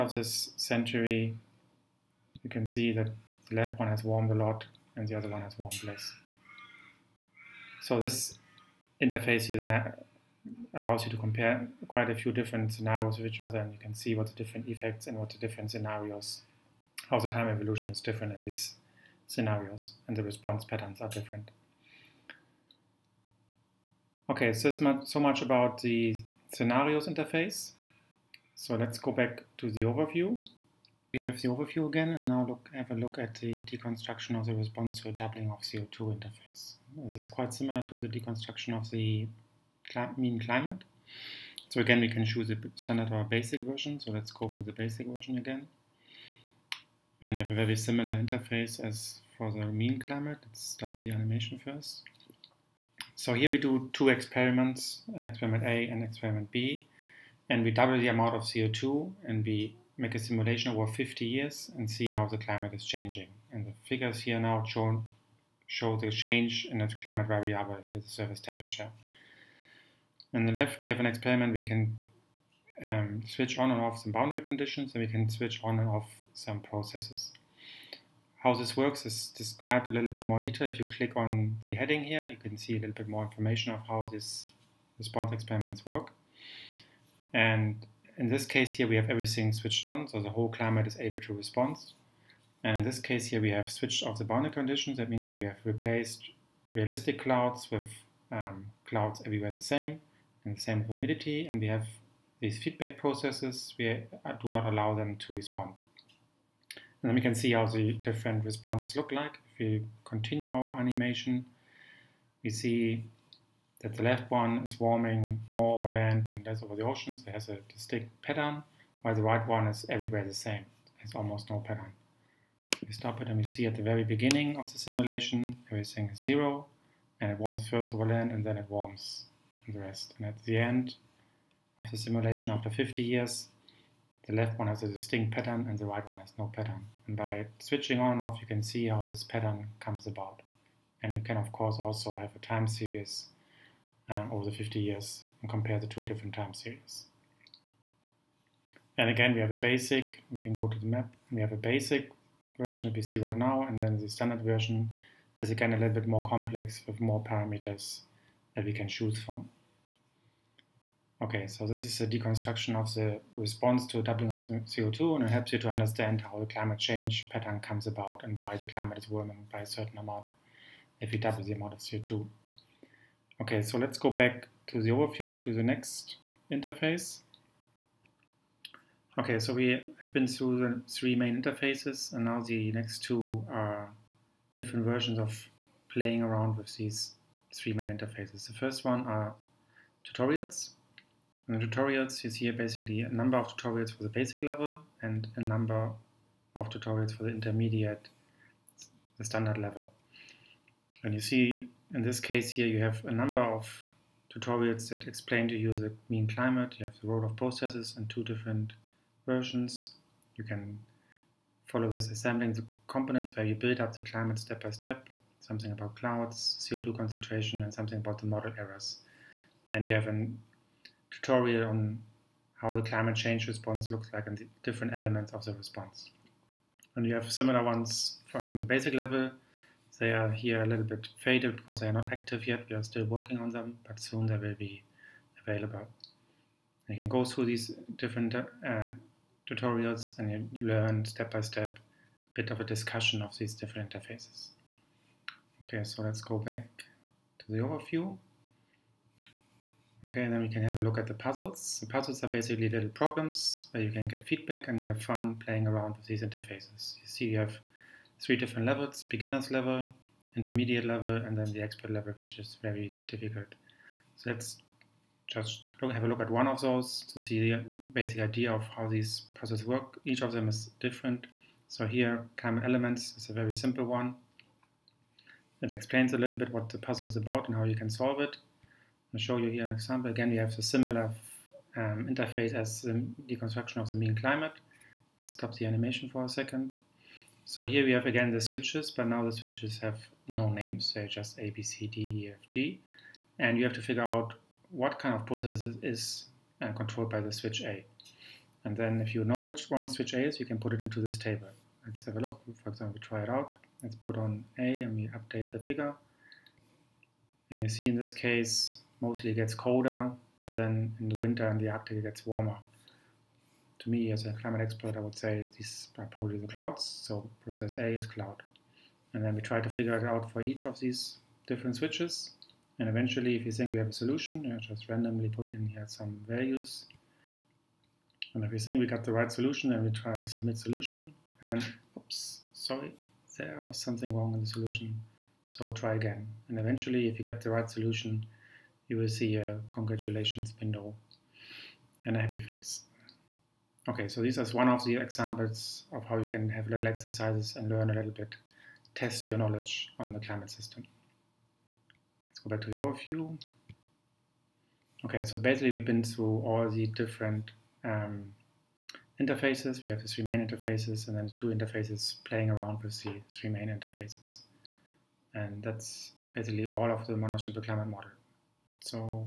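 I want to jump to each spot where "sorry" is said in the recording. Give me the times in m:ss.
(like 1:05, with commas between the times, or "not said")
5:32.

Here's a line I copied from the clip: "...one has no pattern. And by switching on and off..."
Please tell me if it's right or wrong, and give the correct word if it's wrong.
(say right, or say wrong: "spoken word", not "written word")
right.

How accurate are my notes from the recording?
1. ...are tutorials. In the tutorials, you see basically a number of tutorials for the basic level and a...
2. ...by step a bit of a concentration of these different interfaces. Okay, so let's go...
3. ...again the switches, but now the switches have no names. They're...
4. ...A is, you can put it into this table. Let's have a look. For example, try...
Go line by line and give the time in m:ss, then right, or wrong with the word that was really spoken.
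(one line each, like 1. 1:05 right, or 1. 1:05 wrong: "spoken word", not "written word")
1. 3:09 right
2. 4:01 wrong: "discussion", not "concentration"
3. 4:48 right
4. 5:00 right.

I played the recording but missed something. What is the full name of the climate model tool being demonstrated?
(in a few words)
Monash Simple Climate Model.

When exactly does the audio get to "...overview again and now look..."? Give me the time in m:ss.
0:31.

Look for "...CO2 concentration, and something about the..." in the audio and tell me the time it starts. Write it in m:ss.
3:36.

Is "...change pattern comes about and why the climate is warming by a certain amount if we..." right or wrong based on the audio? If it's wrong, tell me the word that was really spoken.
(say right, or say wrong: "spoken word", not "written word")
right.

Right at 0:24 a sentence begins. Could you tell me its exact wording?
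Okay, so, much, so much about the scenarios interface.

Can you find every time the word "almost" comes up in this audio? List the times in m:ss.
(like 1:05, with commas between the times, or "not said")
2:01.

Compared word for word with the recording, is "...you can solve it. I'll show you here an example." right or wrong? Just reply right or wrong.
right.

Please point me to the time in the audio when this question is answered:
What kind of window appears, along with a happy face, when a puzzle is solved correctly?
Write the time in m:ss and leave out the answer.
5:39.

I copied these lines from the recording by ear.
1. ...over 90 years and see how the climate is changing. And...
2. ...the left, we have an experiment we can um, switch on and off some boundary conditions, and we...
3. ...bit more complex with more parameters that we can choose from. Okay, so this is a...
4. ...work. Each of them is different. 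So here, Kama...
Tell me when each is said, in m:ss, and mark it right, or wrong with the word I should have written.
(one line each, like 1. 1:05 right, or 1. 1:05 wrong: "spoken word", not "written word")
1. 1:00 wrong: "50", not "90"
2. 1:10 right
3. 2:35 right
4. 4:29 right.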